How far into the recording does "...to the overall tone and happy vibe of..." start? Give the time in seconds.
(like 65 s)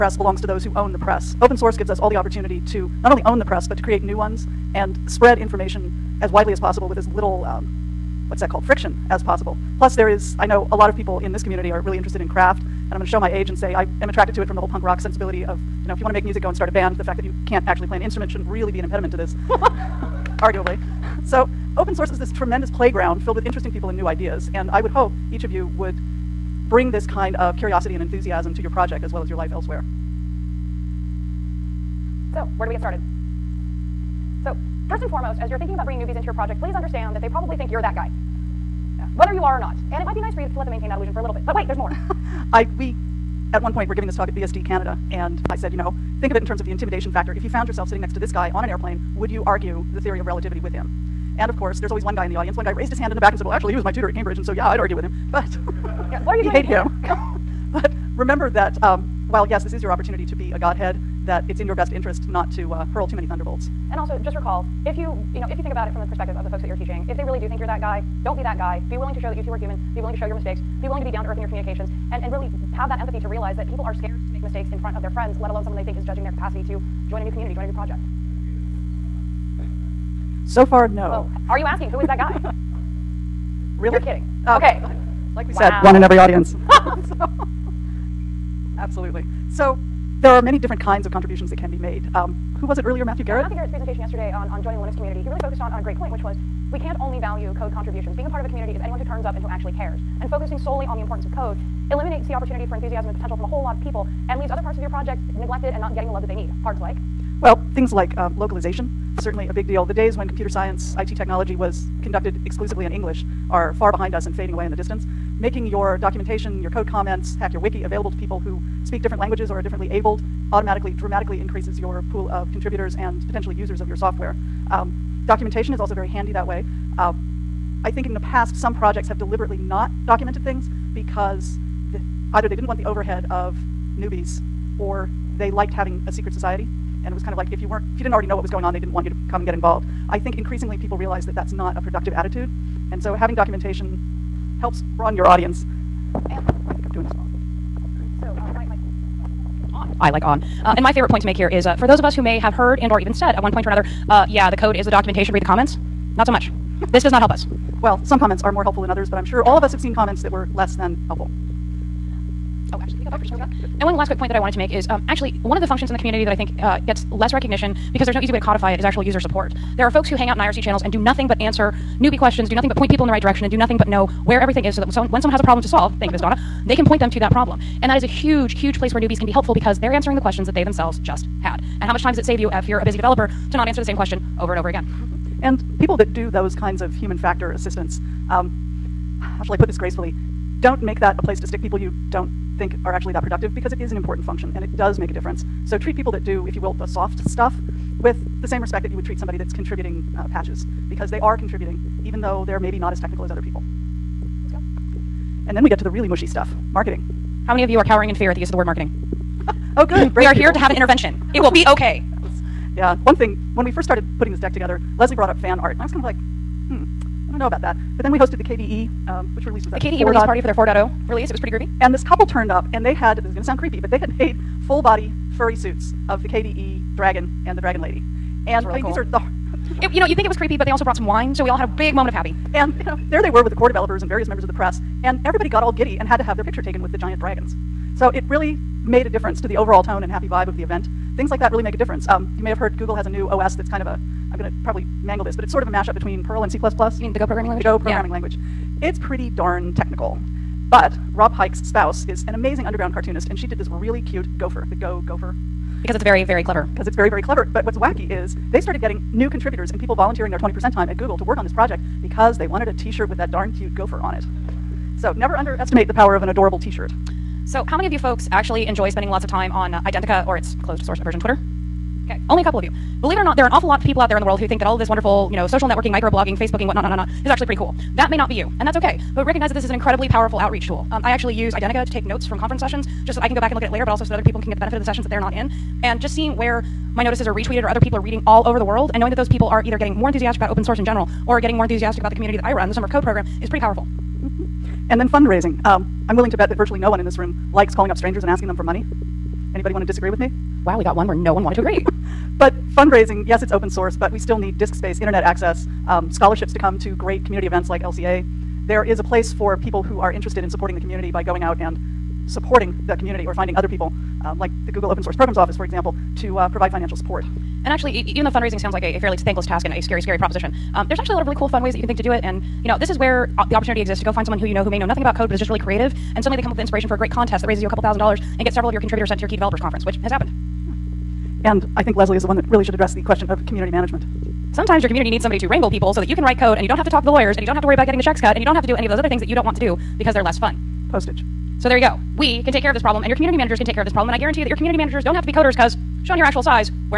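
239 s.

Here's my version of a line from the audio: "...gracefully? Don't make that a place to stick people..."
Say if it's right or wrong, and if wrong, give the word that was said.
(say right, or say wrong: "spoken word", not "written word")
right.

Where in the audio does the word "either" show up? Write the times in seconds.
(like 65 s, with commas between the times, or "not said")
132 s, 289 s.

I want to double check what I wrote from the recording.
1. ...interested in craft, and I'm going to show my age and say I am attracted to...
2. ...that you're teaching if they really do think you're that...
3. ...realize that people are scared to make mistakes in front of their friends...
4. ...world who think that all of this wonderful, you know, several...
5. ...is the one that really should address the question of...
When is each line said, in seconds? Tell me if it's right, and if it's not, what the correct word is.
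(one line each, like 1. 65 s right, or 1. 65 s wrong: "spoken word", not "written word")
1. 11 s right
2. 66 s right
3. 73 s right
4. 274 s wrong: "social", not "several"
5. 332 s right.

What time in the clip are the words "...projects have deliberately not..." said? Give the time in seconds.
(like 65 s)
128 s.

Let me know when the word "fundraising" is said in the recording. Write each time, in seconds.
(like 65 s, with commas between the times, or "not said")
295 s, 302 s, 318 s.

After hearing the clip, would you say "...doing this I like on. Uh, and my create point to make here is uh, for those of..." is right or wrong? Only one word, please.
wrong.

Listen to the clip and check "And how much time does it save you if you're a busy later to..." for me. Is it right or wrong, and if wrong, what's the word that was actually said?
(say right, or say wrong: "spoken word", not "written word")
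wrong: "developer", not "later".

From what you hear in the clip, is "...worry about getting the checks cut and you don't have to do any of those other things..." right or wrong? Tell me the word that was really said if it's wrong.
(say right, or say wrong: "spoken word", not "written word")
right.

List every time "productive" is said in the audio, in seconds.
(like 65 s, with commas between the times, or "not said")
141 s, 193 s.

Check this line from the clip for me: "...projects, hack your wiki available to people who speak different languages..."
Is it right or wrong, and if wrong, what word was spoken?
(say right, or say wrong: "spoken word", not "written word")
wrong: "comments", not "projects".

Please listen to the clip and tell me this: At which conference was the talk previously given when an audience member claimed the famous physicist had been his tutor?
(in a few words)
BSD Canada.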